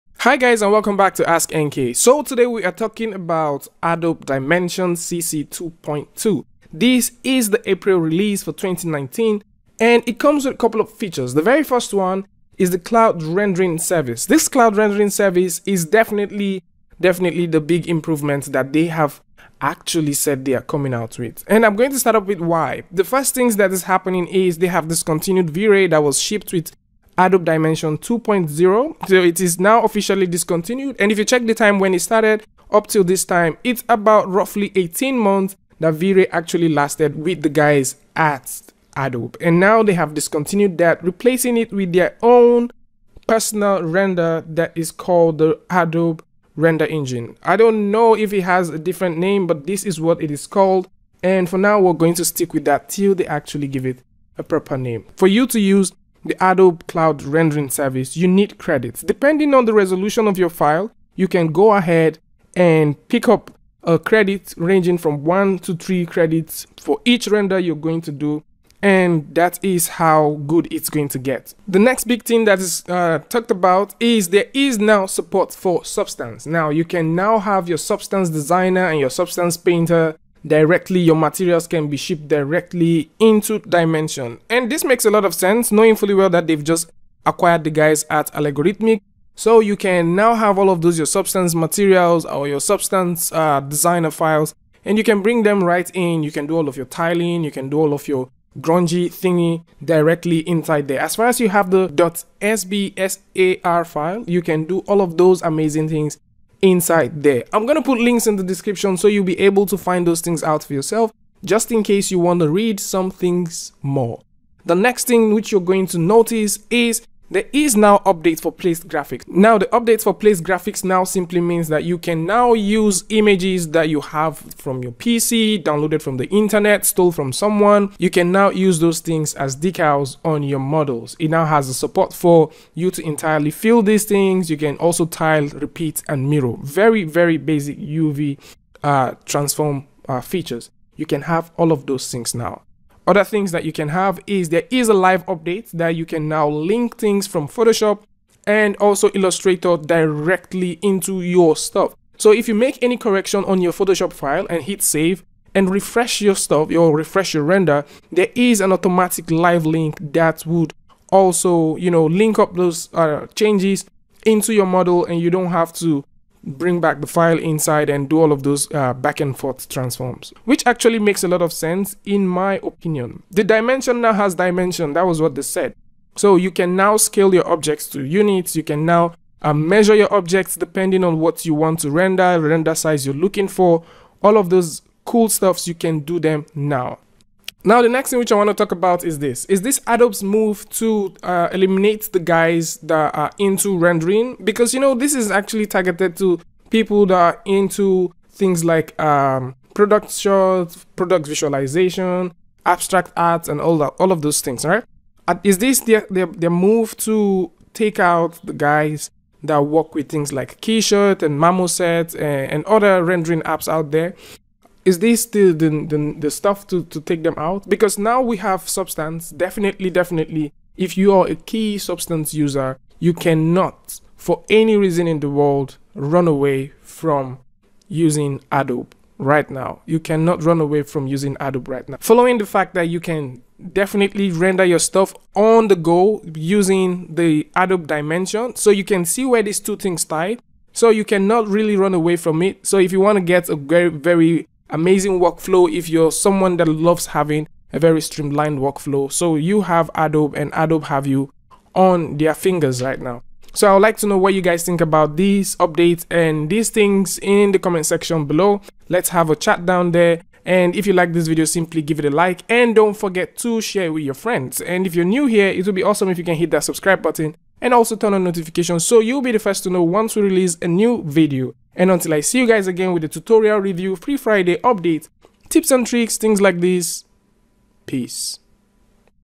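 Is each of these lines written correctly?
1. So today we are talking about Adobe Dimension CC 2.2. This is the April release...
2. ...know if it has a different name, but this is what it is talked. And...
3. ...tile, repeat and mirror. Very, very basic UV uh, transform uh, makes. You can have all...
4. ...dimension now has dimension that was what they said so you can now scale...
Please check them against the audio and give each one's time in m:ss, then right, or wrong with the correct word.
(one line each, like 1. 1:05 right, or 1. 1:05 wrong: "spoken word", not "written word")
1. 0:01 right
2. 0:47 wrong: "called", not "talked"
3. 2:15 wrong: "features", not "makes"
4. 2:53 right.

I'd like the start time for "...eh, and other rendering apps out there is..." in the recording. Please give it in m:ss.
3:32.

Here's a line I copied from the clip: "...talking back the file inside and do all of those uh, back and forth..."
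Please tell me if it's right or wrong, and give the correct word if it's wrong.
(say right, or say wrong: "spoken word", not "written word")
wrong: "bring", not "talking".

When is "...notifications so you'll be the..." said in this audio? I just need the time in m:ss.
4:28.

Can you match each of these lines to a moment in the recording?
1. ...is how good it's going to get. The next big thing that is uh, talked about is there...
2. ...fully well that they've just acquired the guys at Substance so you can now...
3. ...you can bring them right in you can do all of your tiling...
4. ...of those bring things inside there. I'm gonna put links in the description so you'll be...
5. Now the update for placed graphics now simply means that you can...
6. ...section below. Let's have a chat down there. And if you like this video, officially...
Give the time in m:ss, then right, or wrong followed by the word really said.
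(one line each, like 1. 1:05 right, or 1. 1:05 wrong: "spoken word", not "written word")
1. 1:09 right
2. 1:25 wrong: "Allegorithmic", not "Substance"
3. 1:34 right
4. 1:45 wrong: "amazing", not "bring"
5. 1:59 right
6. 4:17 wrong: "simply", not "officially".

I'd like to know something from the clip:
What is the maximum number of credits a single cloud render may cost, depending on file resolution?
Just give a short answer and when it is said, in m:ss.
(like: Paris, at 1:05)
3, at 1:05.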